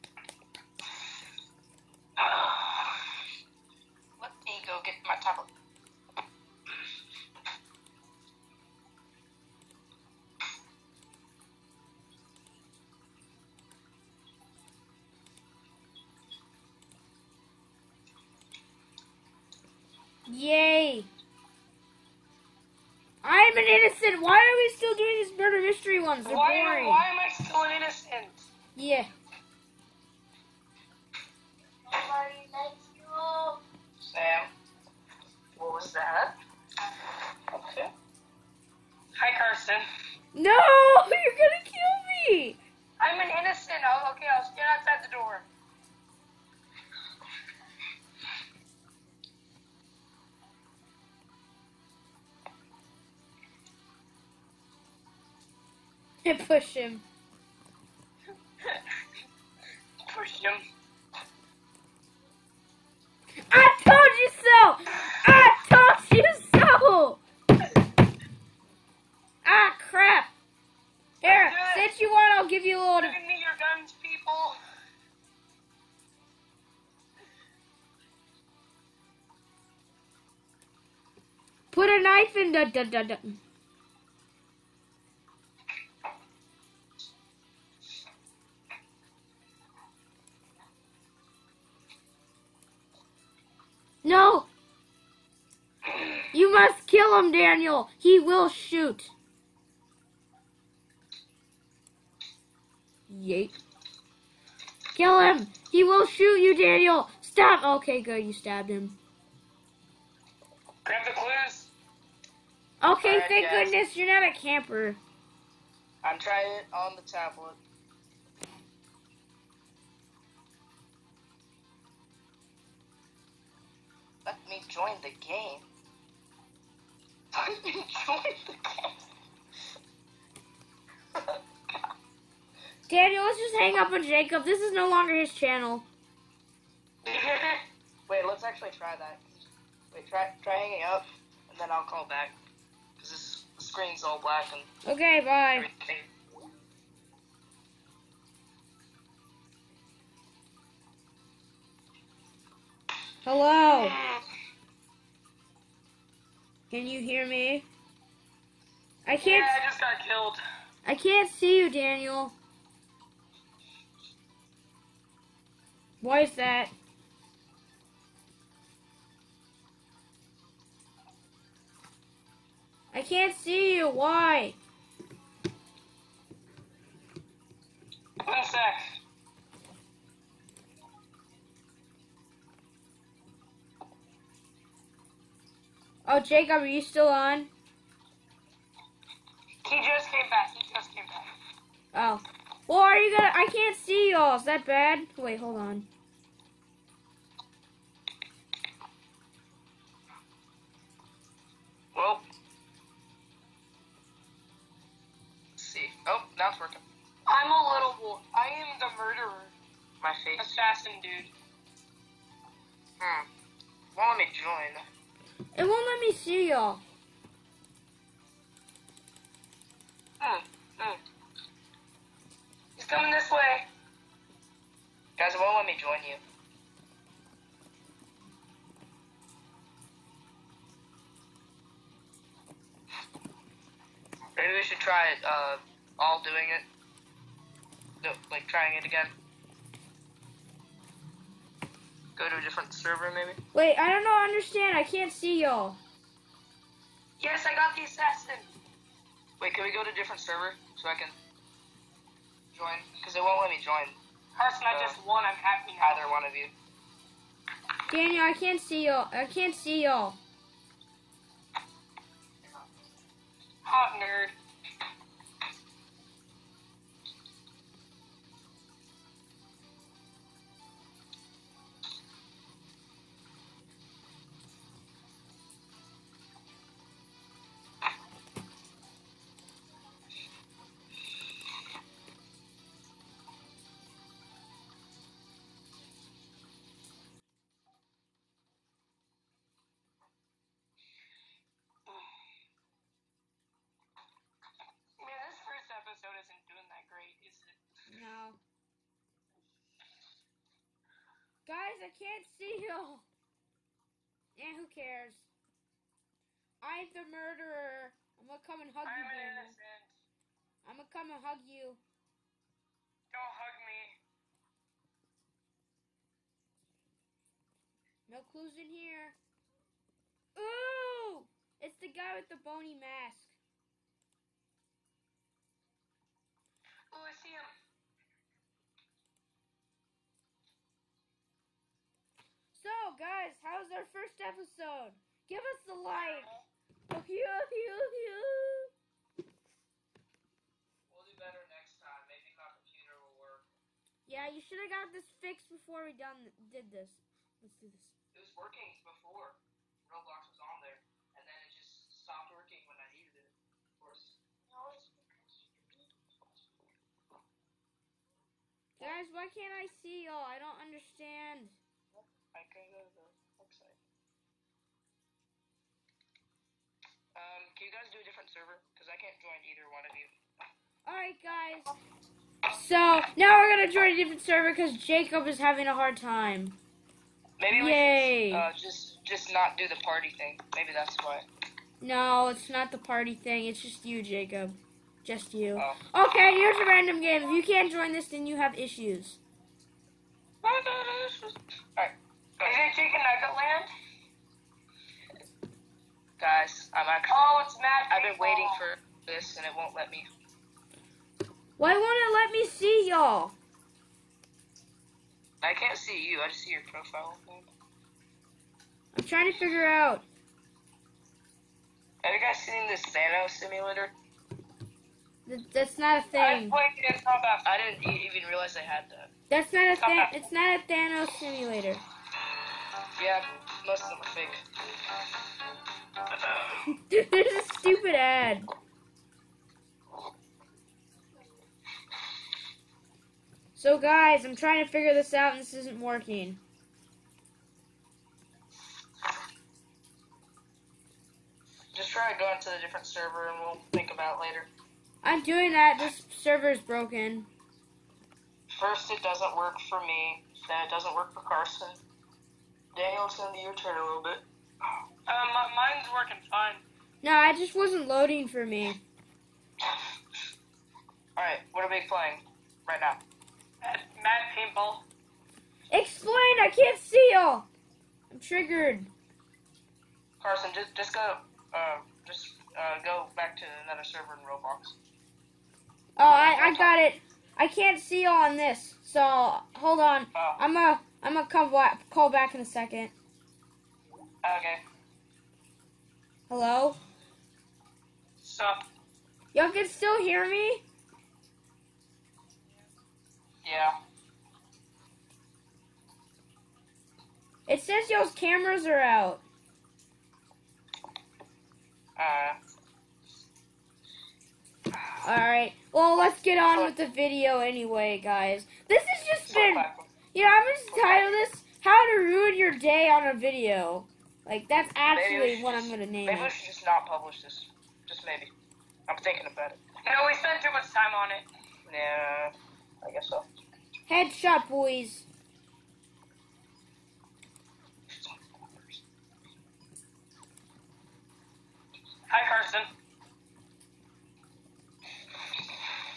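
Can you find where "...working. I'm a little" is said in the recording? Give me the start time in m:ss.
3:26.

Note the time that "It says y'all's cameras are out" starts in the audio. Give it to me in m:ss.
8:17.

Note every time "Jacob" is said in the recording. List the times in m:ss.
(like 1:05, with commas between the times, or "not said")
2:14, 3:06, 6:14, 6:24.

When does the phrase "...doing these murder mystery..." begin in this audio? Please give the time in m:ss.
0:24.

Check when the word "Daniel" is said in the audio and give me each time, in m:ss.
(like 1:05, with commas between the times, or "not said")
1:37, 1:46, 2:12, 2:41, 4:17, 7:32.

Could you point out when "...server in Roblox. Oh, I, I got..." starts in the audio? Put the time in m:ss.
7:53.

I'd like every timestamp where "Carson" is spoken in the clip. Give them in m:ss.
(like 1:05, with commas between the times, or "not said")
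0:39, 4:14, 7:31, 7:50, 8:52.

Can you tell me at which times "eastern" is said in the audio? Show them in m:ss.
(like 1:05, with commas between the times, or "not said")
not said.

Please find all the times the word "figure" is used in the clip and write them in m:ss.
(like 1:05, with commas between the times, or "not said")
6:49, 7:14.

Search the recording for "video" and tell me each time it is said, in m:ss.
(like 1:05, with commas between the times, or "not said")
8:26, 8:33.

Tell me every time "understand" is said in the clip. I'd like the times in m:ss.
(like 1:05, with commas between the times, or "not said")
4:04, 6:00.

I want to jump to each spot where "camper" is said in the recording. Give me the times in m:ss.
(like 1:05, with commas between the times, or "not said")
1:54.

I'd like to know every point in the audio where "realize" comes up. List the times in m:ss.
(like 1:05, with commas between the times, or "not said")
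6:58.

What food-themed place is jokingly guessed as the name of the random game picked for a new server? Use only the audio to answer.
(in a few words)
Chicken Nugget Land.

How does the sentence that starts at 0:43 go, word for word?
I'll, oh, okay, I'll stand outside the door.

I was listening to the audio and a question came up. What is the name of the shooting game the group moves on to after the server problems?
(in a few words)
Mad, mad paintball.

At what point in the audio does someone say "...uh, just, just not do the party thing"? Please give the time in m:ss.
6:18.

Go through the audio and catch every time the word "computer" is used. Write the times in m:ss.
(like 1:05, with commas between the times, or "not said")
5:42.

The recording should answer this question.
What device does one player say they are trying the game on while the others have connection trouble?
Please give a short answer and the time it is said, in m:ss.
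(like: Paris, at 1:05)
Tablet, at 1:57.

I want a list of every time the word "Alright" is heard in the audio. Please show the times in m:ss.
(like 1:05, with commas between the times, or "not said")
6:10, 6:30, 8:25.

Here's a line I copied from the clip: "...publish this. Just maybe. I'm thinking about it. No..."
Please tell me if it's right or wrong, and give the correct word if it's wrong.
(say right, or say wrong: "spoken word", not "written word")
right.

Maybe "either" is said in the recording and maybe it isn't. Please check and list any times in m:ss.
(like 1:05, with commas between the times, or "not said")
4:15, 6:09.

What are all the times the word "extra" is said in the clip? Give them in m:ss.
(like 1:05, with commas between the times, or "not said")
not said.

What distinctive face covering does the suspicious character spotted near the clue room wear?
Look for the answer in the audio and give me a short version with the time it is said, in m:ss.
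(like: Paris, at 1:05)
Bony mask, at 5:22.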